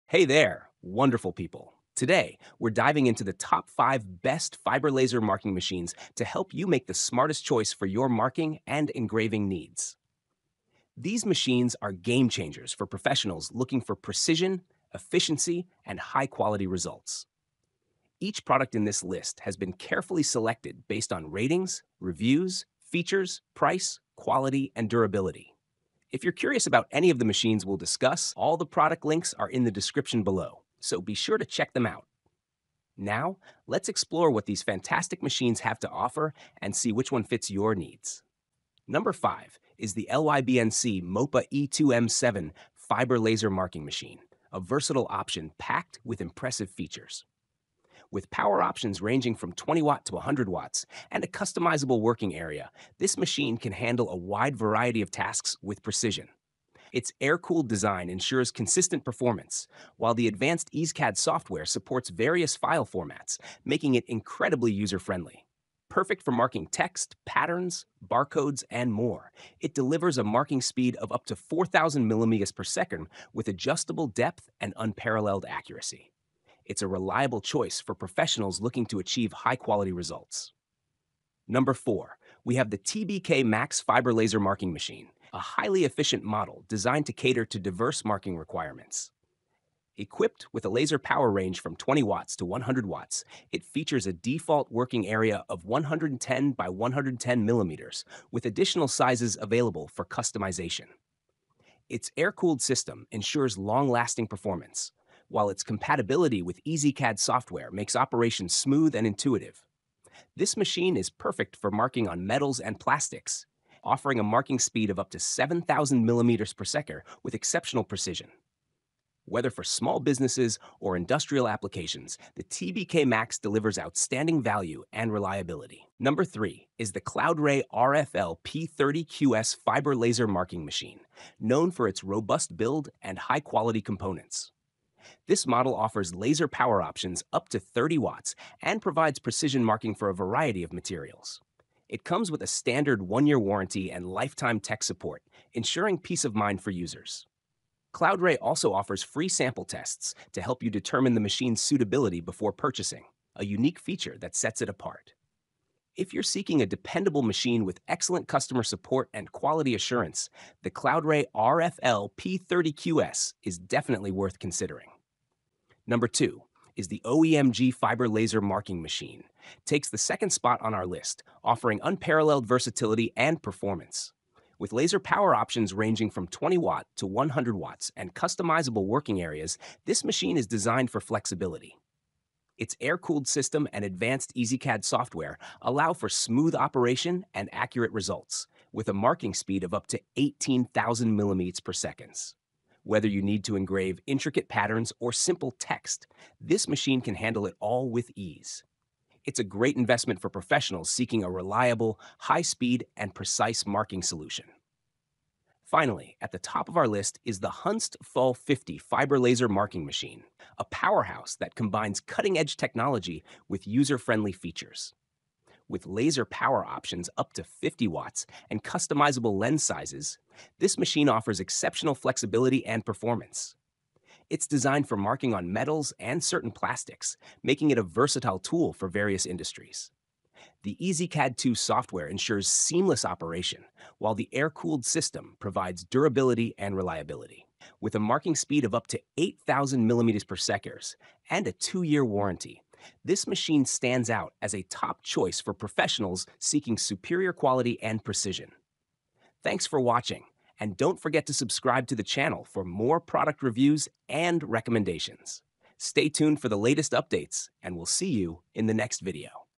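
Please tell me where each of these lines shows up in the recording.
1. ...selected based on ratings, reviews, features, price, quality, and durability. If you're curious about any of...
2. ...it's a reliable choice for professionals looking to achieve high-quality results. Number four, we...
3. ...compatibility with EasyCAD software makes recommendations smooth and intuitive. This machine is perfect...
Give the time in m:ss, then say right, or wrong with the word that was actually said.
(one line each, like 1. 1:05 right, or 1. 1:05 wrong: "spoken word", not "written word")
1. 0:20 right
2. 1:16 right
3. 1:45 wrong: "operations", not "recommendations".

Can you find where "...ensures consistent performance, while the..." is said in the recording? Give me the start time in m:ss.
0:58.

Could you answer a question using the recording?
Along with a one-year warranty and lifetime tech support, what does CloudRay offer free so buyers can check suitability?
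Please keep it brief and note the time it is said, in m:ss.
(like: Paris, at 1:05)
Sample tests, at 2:29.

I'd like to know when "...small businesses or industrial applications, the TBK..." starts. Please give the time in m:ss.
1:59.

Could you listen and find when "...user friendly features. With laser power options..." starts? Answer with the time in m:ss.
3:33.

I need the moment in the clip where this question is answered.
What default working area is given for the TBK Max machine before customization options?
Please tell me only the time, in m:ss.
1:35.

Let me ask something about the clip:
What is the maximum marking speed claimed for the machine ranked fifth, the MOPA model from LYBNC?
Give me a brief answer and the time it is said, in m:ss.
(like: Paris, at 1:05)
4,000 mm/s, at 1:11.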